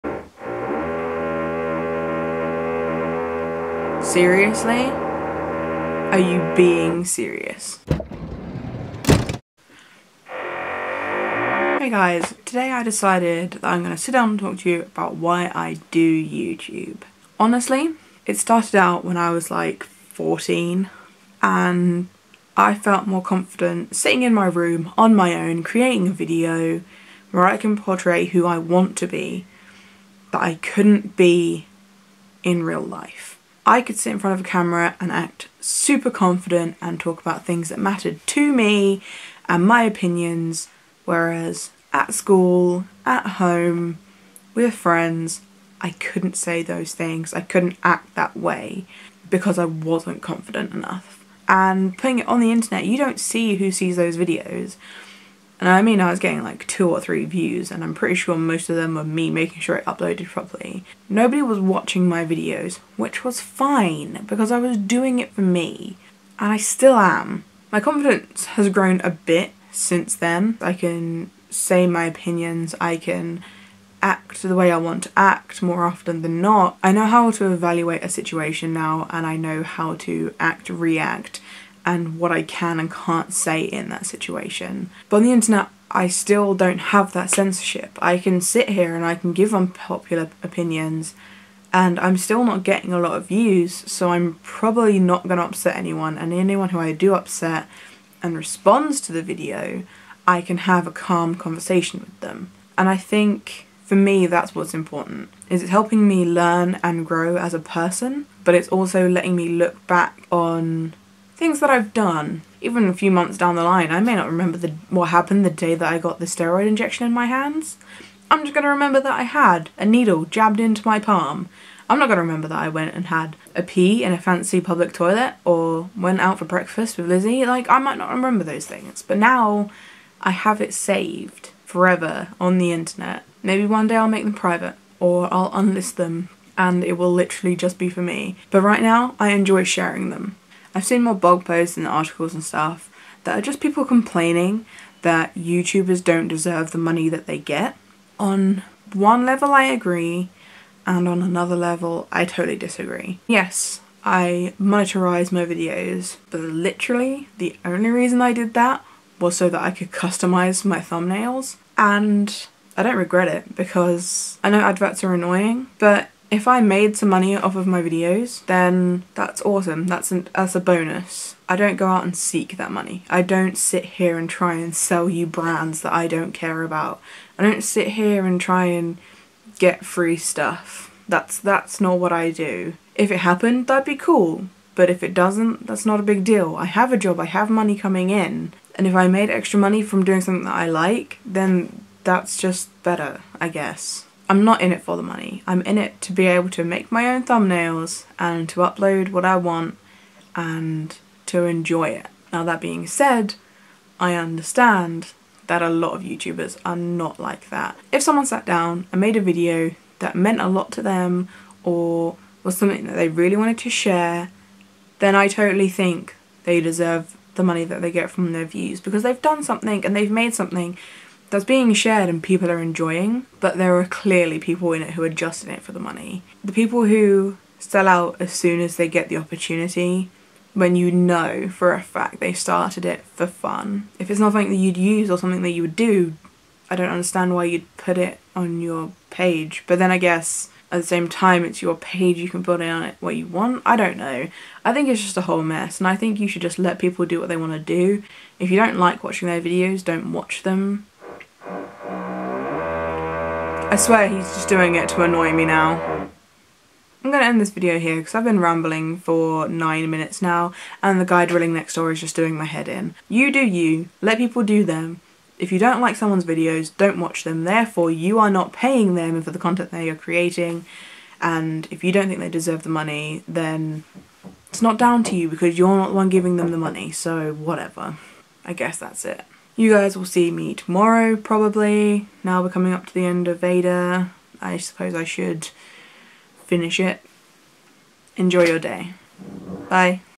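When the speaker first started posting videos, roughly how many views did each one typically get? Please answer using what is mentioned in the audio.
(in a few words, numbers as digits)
2 or 3.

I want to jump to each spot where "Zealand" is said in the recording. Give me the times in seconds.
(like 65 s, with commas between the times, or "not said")
not said.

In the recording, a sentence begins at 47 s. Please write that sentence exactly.
I couldn't act that way because I wasn't confident enough.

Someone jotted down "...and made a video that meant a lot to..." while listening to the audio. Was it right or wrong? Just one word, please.
right.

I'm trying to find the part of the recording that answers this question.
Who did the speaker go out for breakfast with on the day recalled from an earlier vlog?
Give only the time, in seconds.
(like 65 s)
127 s.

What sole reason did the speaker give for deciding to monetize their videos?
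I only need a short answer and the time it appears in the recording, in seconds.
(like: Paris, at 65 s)
Customize my thumbnails, at 159 s.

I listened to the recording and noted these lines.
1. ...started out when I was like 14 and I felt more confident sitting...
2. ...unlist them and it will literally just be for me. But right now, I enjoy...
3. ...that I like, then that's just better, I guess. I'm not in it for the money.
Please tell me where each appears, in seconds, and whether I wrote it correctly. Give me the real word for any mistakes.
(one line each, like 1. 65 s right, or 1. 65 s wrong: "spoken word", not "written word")
1. 18 s right
2. 135 s right
3. 190 s right.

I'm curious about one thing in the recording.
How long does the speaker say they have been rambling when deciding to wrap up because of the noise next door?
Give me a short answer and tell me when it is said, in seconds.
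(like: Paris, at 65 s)
9 minutes, at 259 s.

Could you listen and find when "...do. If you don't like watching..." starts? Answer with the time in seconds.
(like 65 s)
247 s.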